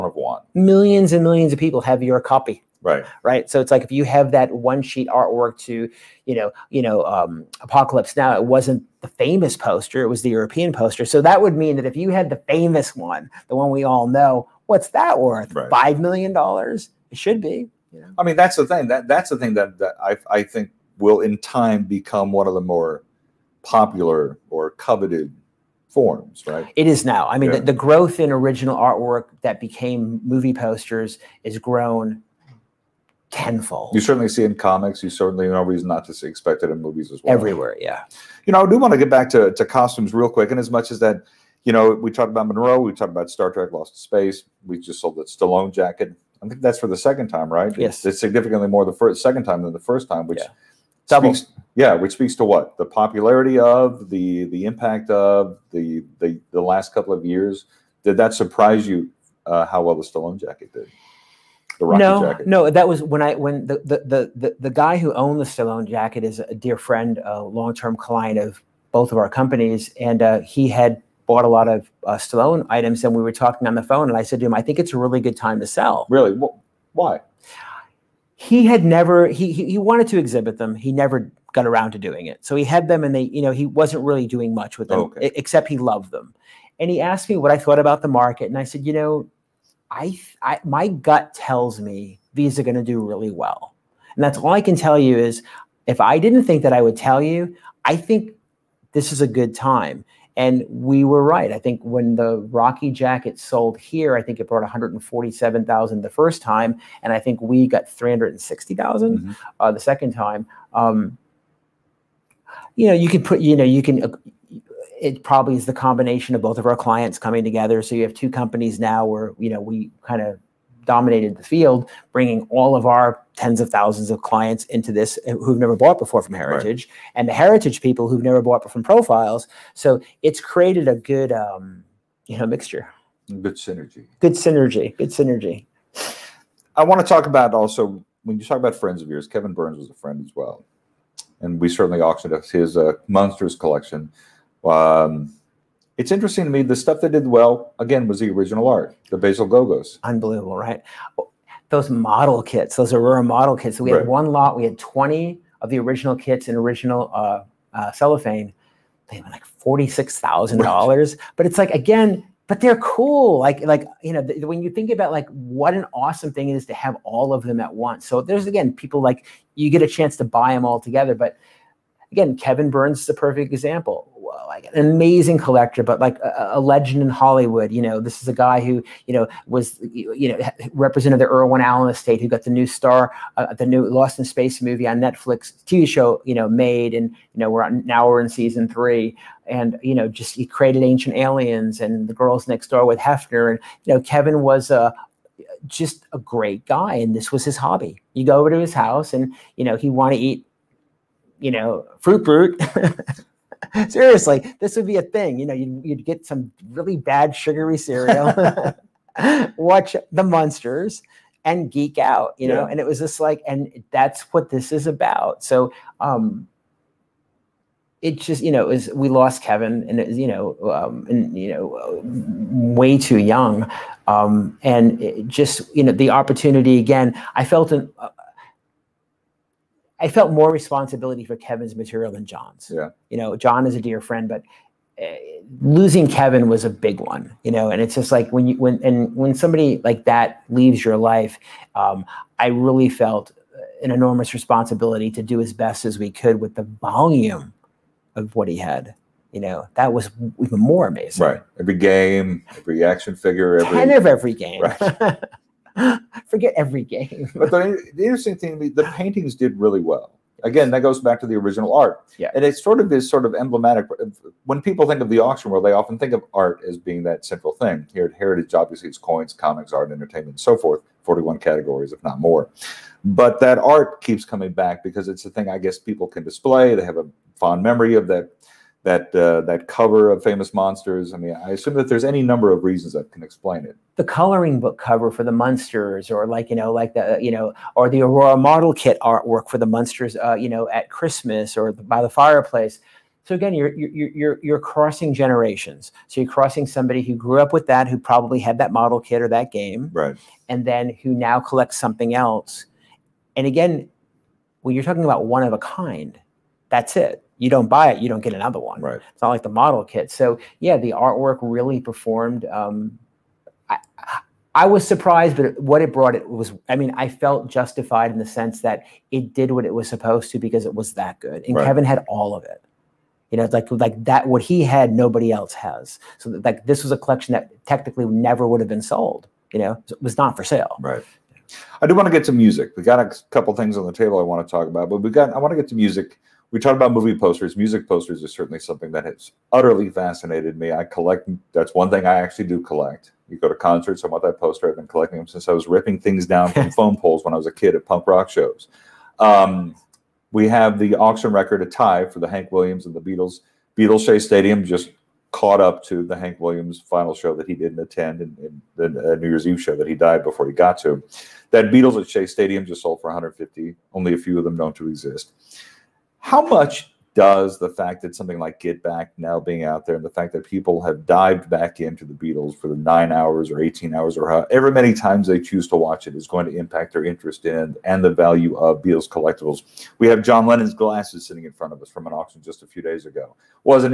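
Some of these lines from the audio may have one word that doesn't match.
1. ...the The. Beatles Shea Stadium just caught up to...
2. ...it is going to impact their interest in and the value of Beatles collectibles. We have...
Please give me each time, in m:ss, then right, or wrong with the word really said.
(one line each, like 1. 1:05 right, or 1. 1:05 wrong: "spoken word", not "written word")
1. 5:52 wrong: "Beatles", not "The"
2. 6:16 right.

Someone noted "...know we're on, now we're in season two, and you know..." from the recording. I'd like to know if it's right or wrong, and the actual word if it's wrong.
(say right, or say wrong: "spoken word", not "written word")
wrong: "three", not "two".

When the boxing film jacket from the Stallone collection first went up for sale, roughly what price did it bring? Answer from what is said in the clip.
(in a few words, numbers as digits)
147,000.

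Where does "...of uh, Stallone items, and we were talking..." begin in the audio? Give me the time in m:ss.
1:11.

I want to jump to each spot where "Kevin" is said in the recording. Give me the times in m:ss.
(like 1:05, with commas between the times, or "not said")
2:19, 2:52, 3:14, 3:39, 3:51, 3:56, 5:21.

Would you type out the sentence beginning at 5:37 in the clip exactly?
Music posters is certainly something that has utterly fascinated me.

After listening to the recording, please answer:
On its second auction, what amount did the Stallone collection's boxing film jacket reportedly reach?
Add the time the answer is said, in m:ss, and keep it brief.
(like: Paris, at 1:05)
360,000, at 1:47.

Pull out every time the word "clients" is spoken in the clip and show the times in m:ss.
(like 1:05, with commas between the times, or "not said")
1:07, 1:56, 2:04.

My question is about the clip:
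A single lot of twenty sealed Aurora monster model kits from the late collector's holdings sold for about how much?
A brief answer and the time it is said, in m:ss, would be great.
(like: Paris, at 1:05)
$46,000, at 2:39.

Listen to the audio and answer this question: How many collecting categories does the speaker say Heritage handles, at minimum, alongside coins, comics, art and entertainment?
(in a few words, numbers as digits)
41.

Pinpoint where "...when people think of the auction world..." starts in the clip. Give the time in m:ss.
4:24.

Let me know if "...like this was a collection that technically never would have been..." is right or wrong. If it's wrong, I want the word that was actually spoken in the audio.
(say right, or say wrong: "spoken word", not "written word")
right.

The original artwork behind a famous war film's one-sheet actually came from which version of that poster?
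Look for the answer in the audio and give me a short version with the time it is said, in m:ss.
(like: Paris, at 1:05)
European poster, at 0:10.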